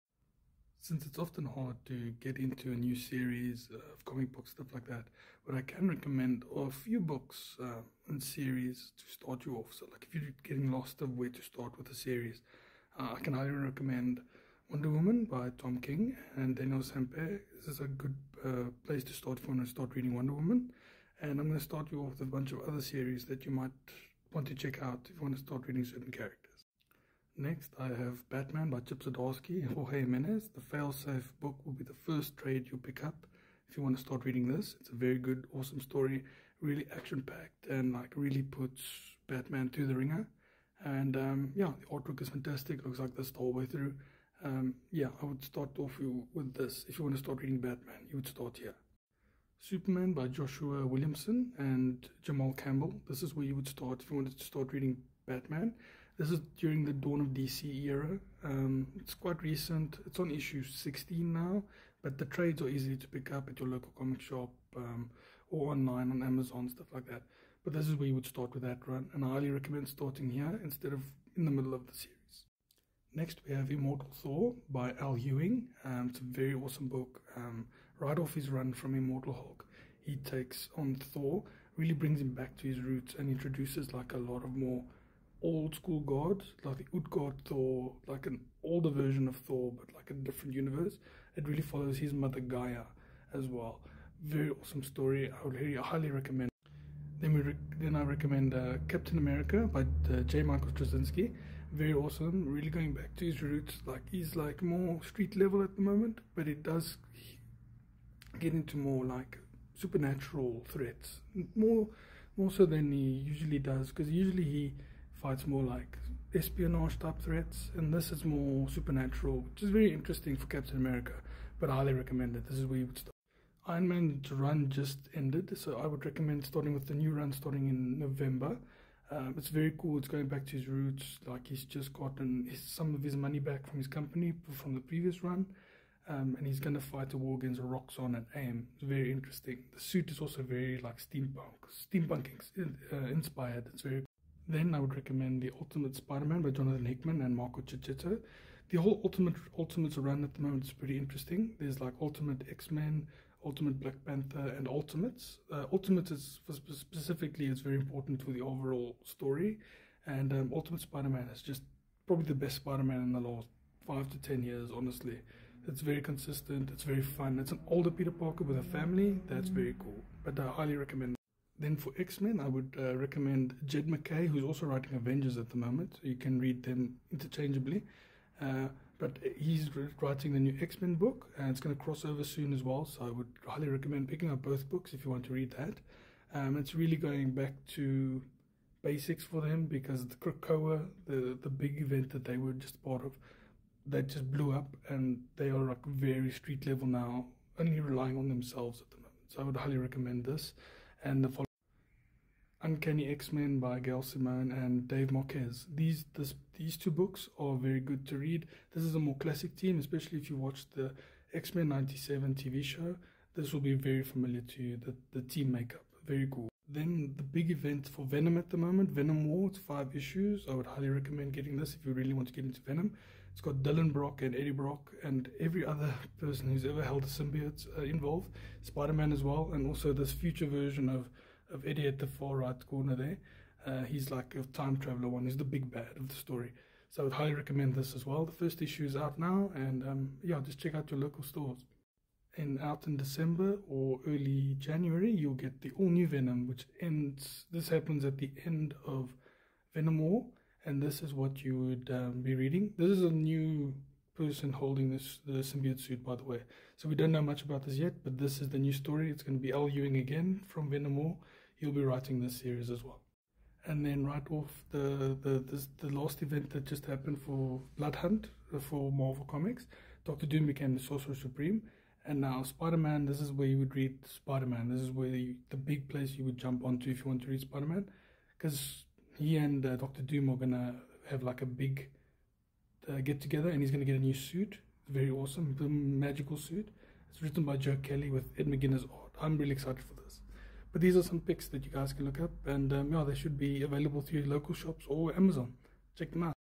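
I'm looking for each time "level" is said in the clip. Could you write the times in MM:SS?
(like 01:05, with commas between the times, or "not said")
01:45, 03:16.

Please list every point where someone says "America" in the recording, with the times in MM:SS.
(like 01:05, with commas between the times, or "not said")
01:39, 02:00.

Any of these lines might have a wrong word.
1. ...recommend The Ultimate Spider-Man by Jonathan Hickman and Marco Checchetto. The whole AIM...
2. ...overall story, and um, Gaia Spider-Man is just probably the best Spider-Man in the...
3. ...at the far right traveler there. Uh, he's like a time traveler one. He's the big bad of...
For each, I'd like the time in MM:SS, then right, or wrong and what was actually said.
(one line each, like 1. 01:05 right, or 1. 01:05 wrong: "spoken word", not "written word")
1. 02:24 wrong: "Ultimate", not "AIM"
2. 02:38 wrong: "Ultimate", not "Gaia"
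3. 03:51 wrong: "corner", not "traveler".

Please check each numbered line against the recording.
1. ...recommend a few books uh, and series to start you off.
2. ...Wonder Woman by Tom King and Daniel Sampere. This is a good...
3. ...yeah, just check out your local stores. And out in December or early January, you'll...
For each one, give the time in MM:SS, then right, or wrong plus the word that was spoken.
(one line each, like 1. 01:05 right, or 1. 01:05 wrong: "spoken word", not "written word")
1. 00:05 right
2. 00:14 right
3. 04:00 right.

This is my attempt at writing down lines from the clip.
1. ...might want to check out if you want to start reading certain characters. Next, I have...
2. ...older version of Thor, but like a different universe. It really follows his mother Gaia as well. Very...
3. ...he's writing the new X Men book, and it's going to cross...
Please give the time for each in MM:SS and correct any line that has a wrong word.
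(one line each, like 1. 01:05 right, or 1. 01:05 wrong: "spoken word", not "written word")
1. 00:23 right
2. 01:28 right
3. 02:59 right.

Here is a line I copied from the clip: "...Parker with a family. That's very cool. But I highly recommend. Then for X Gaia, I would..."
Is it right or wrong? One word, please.
wrong.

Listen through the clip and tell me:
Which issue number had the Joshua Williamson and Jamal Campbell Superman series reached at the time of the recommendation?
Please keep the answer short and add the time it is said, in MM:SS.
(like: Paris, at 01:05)
16, at 01:00.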